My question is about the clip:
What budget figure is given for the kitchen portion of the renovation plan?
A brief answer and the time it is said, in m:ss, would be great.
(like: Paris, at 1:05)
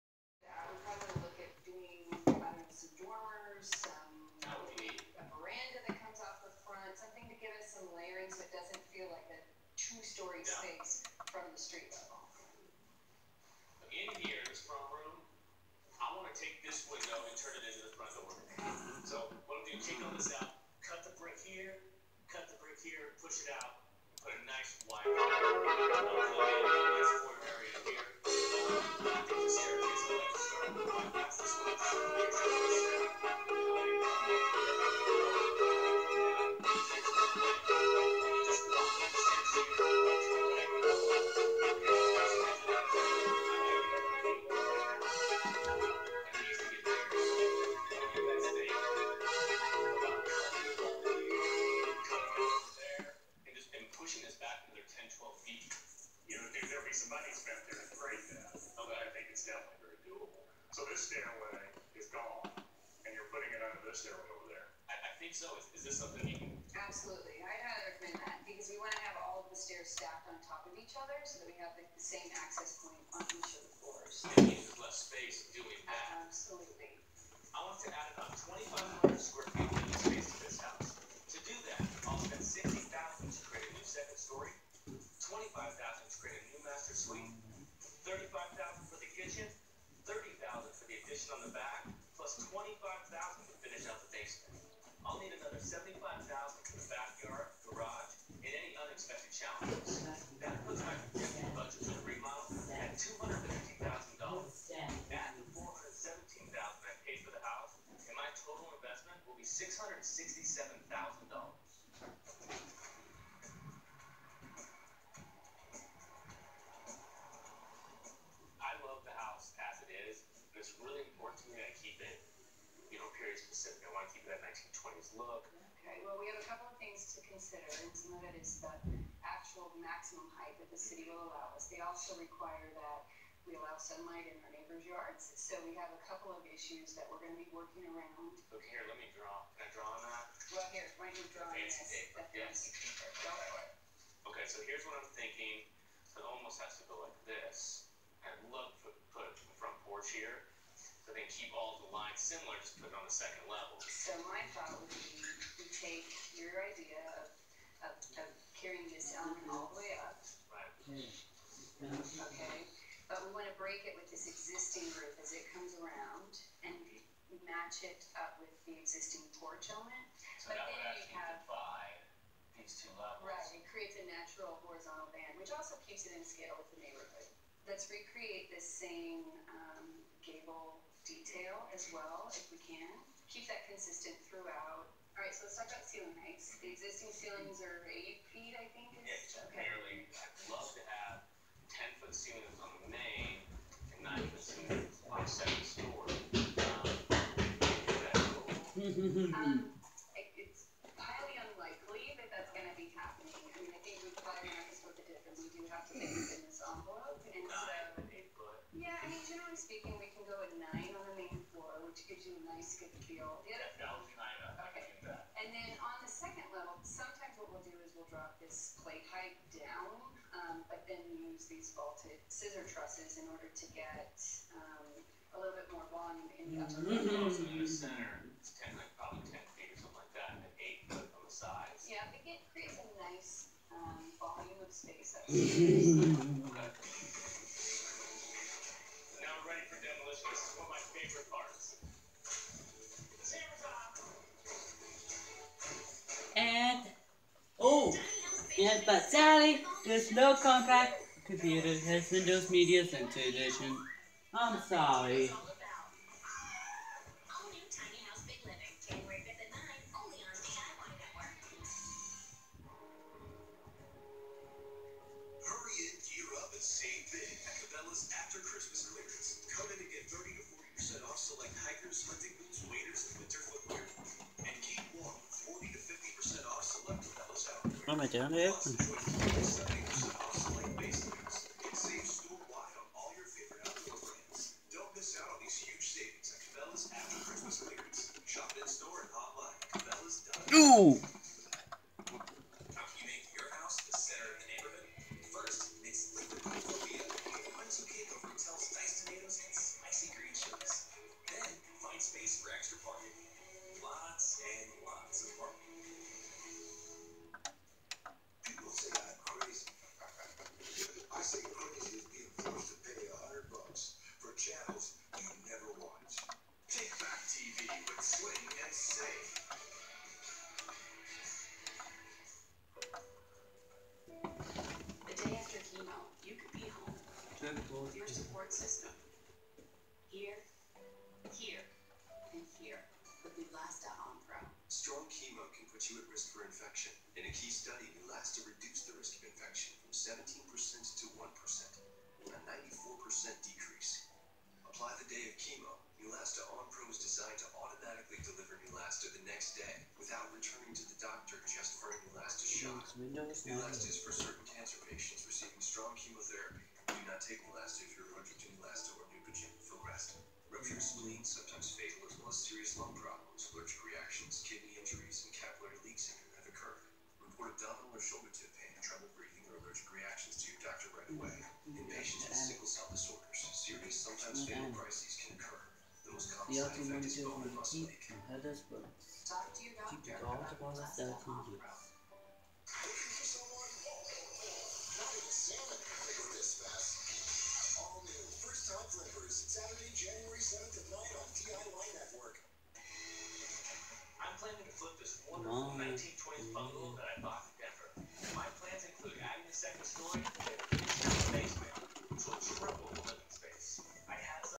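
$35,000, at 1:28.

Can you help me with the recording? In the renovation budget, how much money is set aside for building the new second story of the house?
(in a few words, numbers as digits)
$60,000.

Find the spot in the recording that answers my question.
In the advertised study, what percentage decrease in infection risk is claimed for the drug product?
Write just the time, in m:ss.
5:42.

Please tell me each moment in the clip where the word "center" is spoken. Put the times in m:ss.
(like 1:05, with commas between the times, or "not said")
3:47, 4:12.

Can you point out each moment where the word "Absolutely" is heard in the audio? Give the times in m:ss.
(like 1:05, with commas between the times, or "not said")
1:06, 1:16.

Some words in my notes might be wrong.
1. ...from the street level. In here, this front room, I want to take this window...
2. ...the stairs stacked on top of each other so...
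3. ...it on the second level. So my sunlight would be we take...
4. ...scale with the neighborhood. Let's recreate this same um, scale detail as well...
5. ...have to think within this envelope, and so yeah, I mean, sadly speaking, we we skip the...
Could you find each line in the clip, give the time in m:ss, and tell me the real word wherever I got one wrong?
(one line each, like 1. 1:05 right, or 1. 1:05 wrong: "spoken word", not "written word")
1. 0:11 right
2. 1:09 right
3. 2:32 wrong: "thought", not "sunlight"
4. 2:56 wrong: "gable", not "scale"
5. 3:25 wrong: "generally", not "sadly".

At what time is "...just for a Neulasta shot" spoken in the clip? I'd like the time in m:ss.
5:51.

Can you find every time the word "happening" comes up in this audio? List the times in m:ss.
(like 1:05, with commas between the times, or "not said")
3:22.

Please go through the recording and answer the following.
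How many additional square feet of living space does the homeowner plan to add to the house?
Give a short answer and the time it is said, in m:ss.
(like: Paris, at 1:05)
2,500, at 1:19.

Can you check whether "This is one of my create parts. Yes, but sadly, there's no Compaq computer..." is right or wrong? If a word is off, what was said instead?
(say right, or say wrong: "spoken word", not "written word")
wrong: "favorite", not "create".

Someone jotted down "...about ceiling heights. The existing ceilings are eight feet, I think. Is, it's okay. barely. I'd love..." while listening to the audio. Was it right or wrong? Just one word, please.
right.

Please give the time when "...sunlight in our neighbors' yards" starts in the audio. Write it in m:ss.
2:13.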